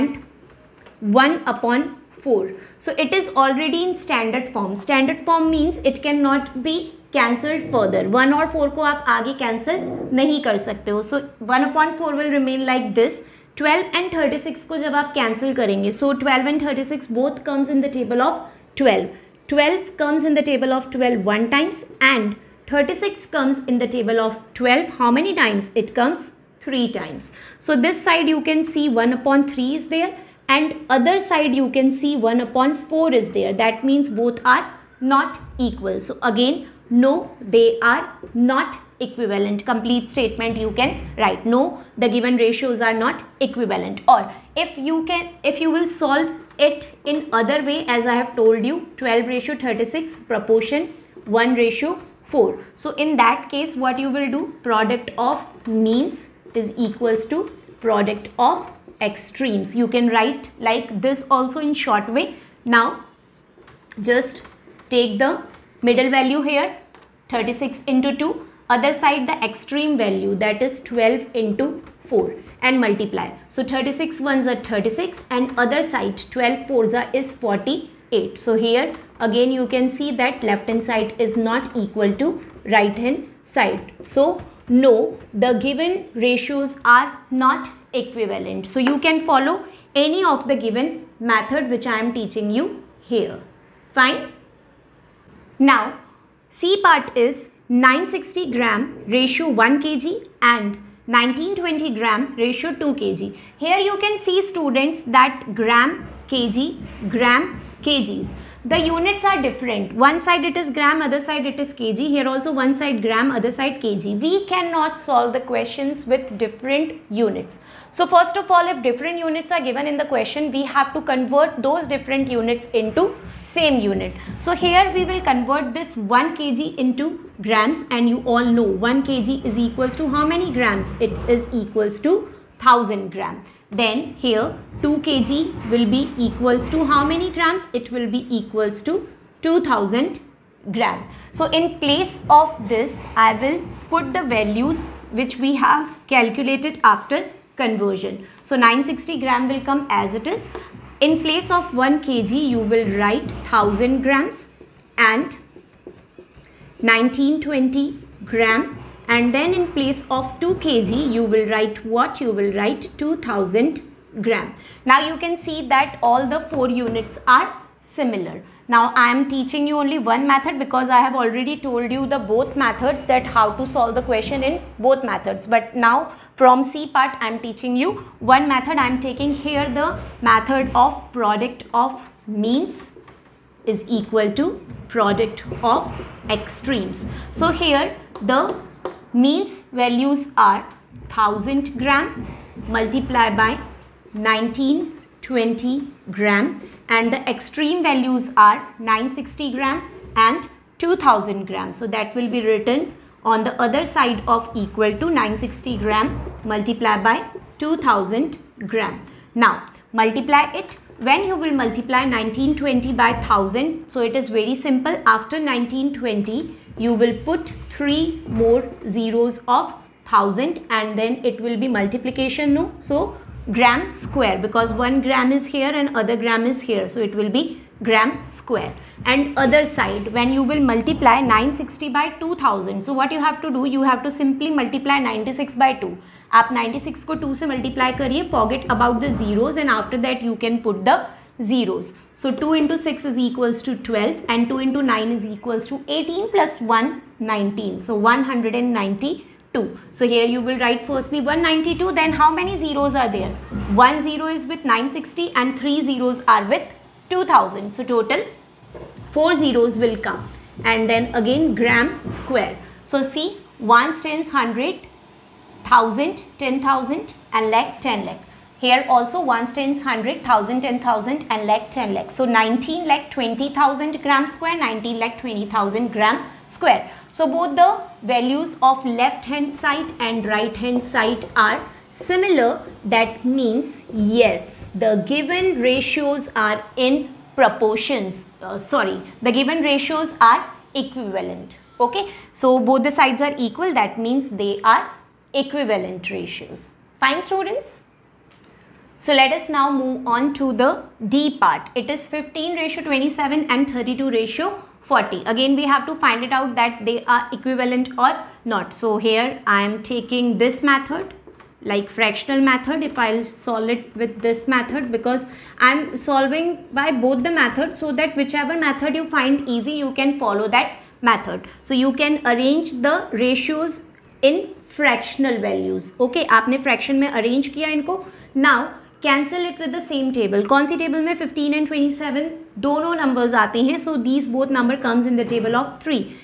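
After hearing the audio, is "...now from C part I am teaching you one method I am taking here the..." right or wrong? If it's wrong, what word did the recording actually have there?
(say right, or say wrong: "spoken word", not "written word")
right.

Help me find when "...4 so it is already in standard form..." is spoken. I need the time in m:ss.
0:02.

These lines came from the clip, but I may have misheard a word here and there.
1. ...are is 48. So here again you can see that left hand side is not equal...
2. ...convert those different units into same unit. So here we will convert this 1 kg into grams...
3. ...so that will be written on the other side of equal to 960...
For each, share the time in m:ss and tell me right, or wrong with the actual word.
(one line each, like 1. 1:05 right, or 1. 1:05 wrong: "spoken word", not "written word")
1. 1:16 right
2. 2:01 right
3. 3:21 right.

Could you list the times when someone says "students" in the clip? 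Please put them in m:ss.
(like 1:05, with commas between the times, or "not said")
1:44, 4:57.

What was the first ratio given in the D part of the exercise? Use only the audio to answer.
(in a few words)
15:27.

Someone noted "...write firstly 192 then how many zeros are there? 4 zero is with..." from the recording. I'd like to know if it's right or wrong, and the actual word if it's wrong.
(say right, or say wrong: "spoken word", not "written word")
wrong: "1", not "4".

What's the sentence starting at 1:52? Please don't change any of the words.
Here also one side gram, other side kg.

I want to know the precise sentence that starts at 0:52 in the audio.
So in that case what you will do product of means is equals to product of extremes.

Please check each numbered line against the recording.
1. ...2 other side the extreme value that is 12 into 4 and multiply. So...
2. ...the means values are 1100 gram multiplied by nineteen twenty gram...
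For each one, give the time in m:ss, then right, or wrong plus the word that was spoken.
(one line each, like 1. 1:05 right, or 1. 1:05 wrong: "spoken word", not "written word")
1. 1:08 right
2. 3:08 wrong: "1000", not "1100".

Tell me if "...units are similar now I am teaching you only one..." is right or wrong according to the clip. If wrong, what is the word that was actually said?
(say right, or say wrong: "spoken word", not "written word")
right.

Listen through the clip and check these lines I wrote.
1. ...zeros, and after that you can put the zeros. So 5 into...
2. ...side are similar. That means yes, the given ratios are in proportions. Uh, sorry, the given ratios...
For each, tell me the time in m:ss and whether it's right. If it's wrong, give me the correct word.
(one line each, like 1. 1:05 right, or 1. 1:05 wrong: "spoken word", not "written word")
1. 3:59 wrong: "2", not "5"
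2. 4:40 right.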